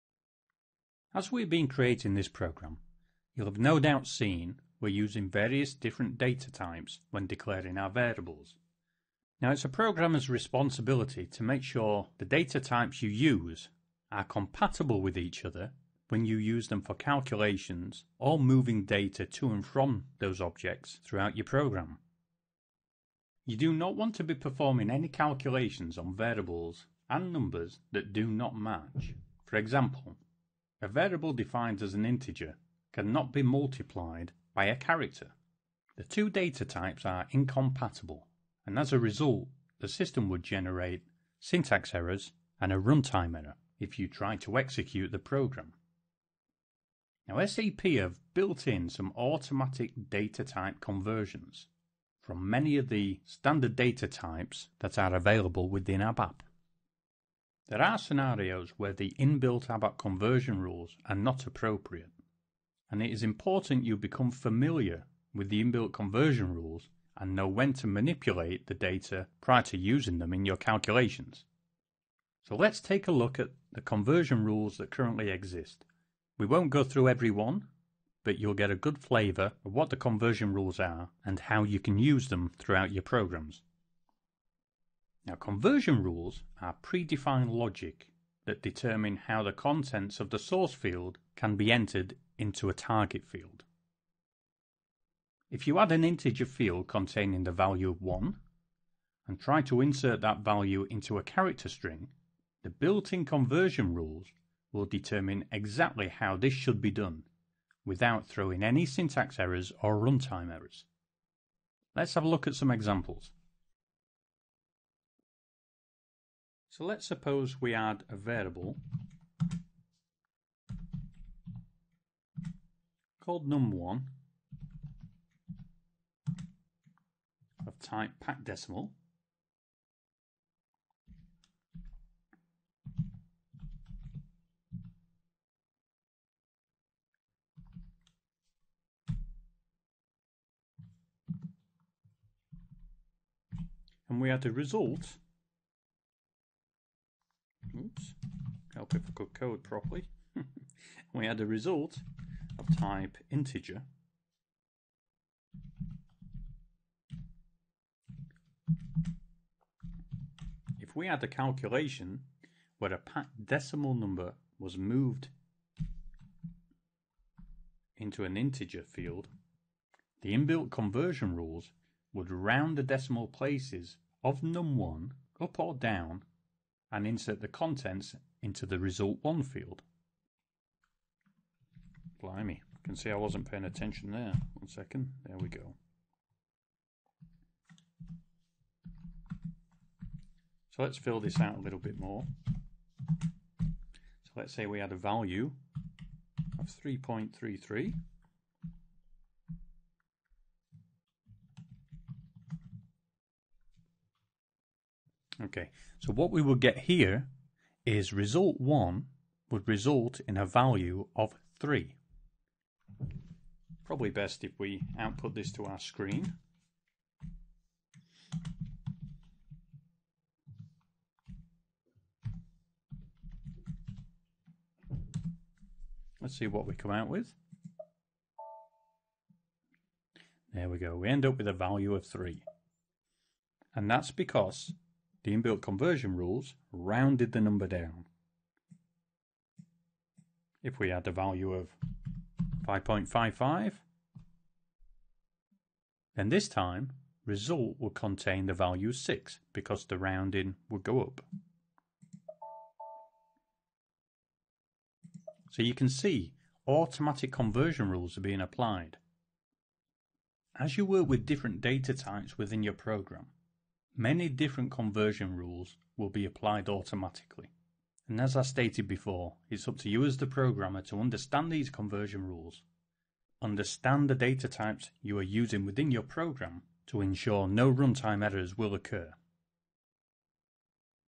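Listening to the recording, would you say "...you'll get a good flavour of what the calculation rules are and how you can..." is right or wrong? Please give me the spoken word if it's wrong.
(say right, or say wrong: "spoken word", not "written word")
wrong: "conversion", not "calculation".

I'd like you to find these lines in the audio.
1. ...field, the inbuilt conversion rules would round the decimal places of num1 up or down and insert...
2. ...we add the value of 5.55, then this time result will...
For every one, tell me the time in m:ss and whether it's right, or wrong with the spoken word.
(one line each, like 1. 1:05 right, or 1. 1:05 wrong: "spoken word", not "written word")
1. 2:48 right
2. 4:00 right.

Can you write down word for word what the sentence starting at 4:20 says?
As you work with different data types within your program, Many different conversion rules will be applied automatically.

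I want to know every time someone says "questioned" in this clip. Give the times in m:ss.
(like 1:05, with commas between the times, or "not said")
not said.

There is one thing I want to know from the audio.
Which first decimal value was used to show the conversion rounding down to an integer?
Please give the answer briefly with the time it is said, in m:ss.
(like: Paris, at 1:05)
3.33, at 3:16.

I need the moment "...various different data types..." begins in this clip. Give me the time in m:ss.
0:05.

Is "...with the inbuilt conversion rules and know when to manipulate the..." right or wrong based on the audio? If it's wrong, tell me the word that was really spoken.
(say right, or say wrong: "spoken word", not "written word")
right.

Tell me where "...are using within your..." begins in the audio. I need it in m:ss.
4:35.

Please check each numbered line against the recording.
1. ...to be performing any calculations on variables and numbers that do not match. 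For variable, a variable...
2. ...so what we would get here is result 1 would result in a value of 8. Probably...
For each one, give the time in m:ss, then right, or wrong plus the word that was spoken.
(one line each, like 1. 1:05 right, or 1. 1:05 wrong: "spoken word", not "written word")
1. 0:24 wrong: "example", not "variable"
2. 3:25 wrong: "3", not "8".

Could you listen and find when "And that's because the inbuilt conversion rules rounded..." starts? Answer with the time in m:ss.
3:53.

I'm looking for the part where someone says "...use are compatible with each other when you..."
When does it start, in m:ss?
0:13.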